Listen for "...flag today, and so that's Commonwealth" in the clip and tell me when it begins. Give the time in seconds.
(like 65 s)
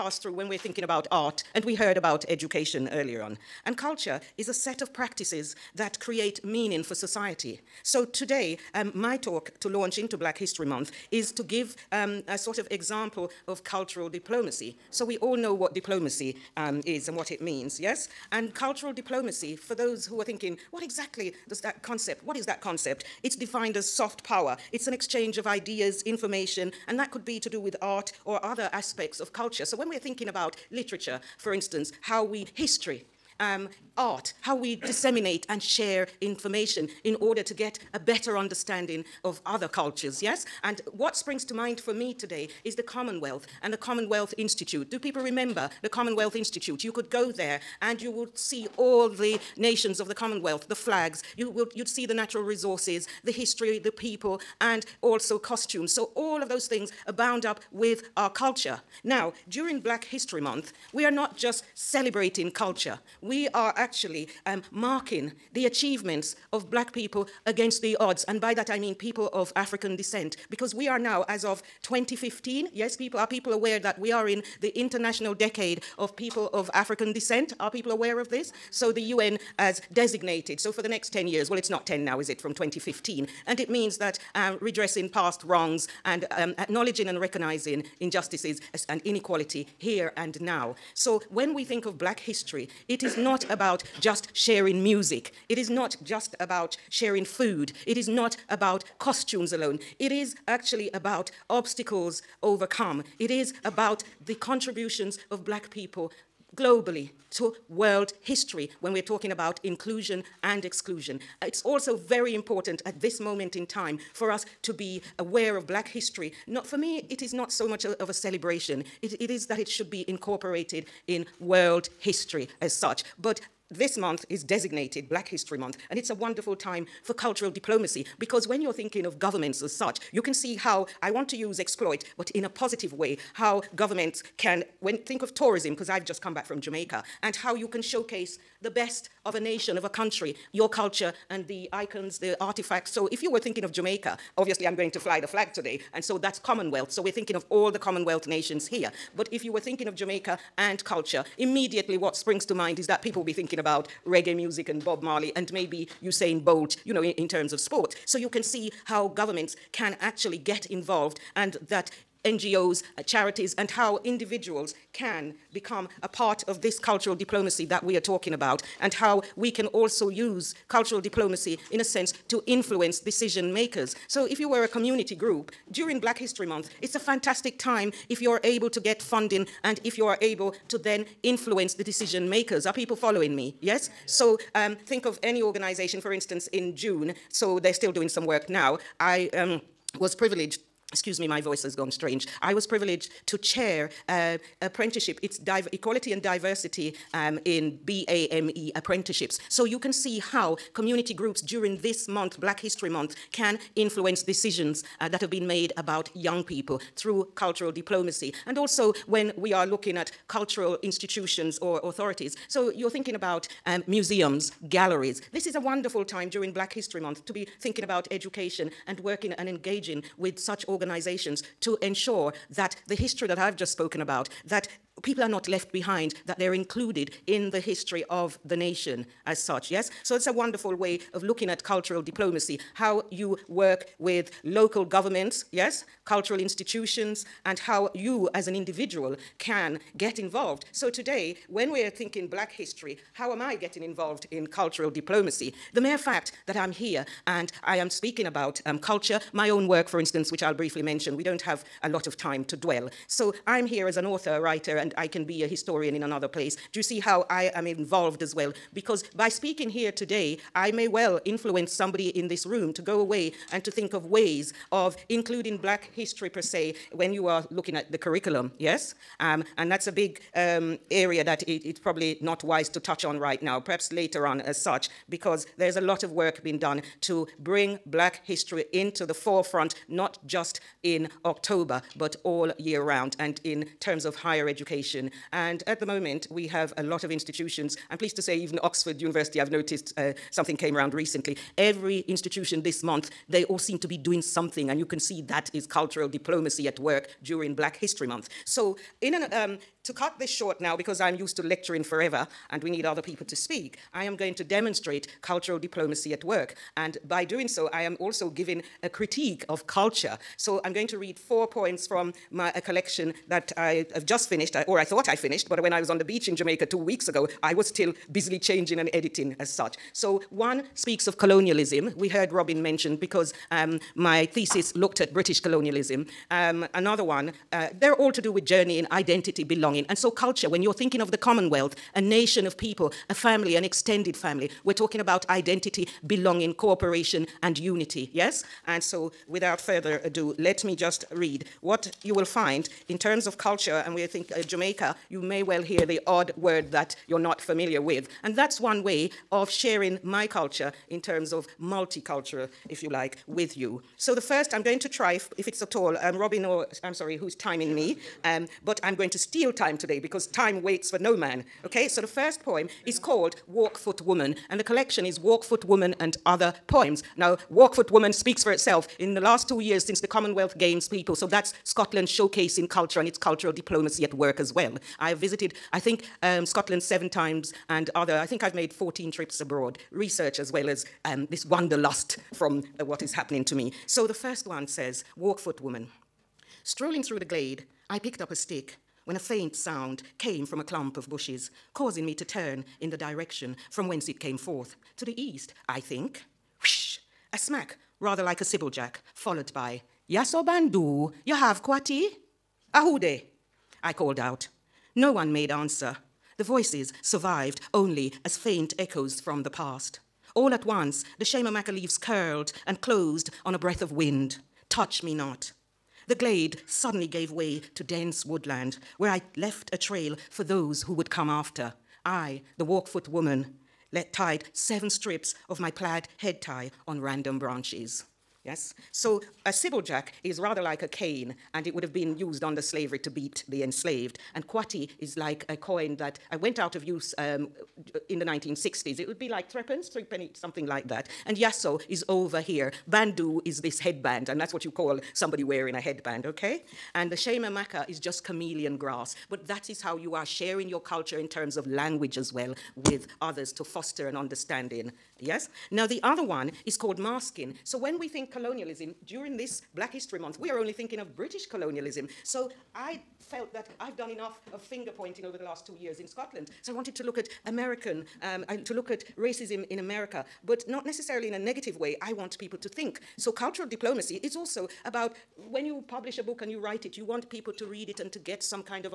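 145 s.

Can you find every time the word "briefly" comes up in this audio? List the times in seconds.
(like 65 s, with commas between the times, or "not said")
250 s.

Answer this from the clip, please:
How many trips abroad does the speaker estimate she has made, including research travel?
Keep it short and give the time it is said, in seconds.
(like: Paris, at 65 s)
14, at 378 s.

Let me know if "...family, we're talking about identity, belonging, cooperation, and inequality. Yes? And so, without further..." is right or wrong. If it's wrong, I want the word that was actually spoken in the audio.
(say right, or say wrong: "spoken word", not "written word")
wrong: "unity", not "inequality".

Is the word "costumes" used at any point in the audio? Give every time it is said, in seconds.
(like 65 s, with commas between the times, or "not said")
55 s, 98 s.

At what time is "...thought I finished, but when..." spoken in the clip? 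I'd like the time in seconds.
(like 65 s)
314 s.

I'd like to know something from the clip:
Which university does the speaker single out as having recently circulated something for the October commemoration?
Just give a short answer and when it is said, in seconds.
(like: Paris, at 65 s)
Oxford University, at 288 s.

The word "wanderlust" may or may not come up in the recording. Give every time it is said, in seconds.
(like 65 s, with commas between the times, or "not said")
381 s.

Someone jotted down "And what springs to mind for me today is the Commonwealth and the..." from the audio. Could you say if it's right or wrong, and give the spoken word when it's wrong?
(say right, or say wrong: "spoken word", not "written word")
right.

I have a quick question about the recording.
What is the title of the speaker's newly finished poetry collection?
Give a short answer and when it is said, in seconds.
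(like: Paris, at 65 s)
Walkfoot Woman and Other Poems, at 365 s.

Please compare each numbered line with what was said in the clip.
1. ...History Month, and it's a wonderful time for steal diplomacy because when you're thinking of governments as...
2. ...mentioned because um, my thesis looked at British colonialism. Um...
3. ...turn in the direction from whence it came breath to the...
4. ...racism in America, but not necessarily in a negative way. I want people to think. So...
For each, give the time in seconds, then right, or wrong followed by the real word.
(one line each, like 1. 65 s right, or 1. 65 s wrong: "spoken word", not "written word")
1. 125 s wrong: "cultural", not "steal"
2. 322 s right
3. 392 s wrong: "forth", not "breath"
4. 469 s right.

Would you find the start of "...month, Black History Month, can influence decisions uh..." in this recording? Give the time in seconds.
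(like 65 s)
202 s.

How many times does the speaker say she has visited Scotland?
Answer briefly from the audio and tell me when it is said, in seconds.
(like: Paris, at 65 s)
7, at 376 s.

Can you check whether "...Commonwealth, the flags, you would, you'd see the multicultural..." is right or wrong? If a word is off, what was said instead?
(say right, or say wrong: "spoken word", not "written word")
wrong: "natural", not "multicultural".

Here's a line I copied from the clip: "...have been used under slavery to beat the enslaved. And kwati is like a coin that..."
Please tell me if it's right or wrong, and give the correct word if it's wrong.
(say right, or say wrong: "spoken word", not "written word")
right.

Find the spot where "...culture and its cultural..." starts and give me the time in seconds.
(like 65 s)
372 s.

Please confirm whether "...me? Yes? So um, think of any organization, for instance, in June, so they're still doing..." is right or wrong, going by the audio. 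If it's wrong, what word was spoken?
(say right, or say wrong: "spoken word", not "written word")
right.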